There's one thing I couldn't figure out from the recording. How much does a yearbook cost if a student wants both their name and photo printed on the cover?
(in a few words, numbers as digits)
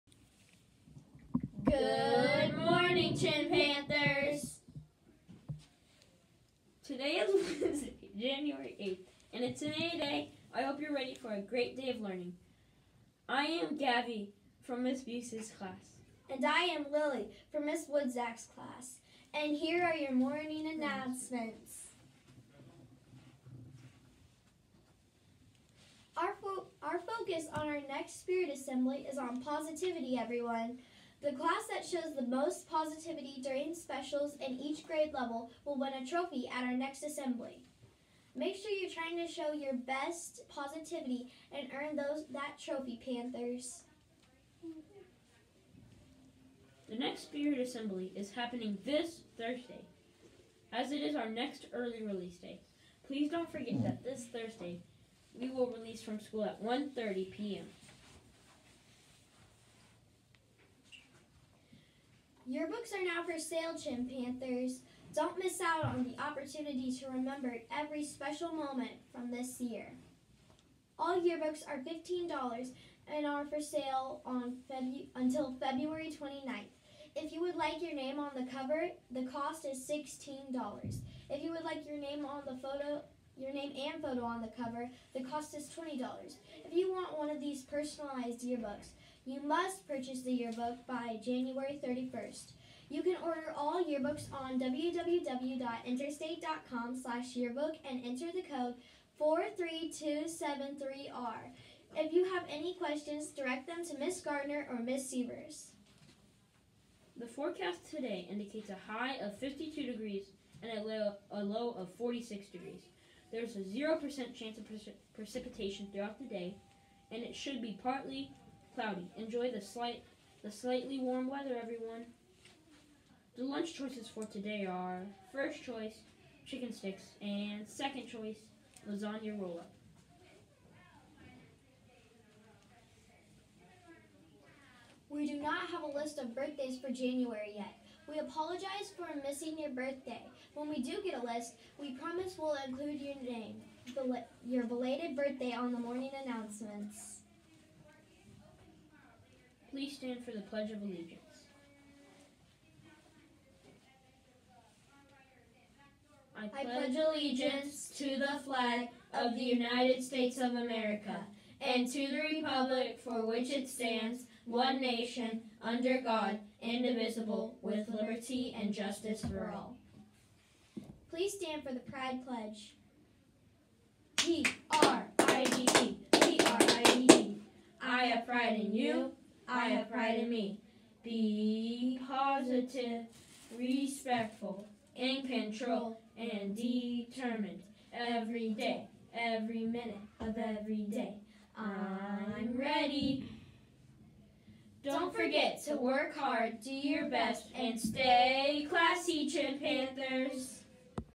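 $20.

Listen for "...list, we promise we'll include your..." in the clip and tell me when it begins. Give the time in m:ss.
2:21.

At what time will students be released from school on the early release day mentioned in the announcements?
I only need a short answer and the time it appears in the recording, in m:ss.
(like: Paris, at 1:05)
1:30 p.m., at 0:56.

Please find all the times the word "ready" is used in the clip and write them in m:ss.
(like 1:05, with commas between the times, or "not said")
0:10, 3:12.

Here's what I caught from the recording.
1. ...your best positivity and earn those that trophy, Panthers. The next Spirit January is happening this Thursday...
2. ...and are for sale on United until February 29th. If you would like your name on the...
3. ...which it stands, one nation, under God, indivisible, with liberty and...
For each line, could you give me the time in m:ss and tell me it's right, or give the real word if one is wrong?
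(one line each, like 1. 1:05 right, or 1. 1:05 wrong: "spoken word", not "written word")
1. 0:39 wrong: "Assembly", not "January"
2. 1:13 wrong: "Febu", not "United"
3. 2:43 right.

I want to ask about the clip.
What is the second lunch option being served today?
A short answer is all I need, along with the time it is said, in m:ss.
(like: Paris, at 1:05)
Lasagna roll up, at 2:08.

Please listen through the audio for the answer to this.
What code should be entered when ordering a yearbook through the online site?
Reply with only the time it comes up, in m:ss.
1:39.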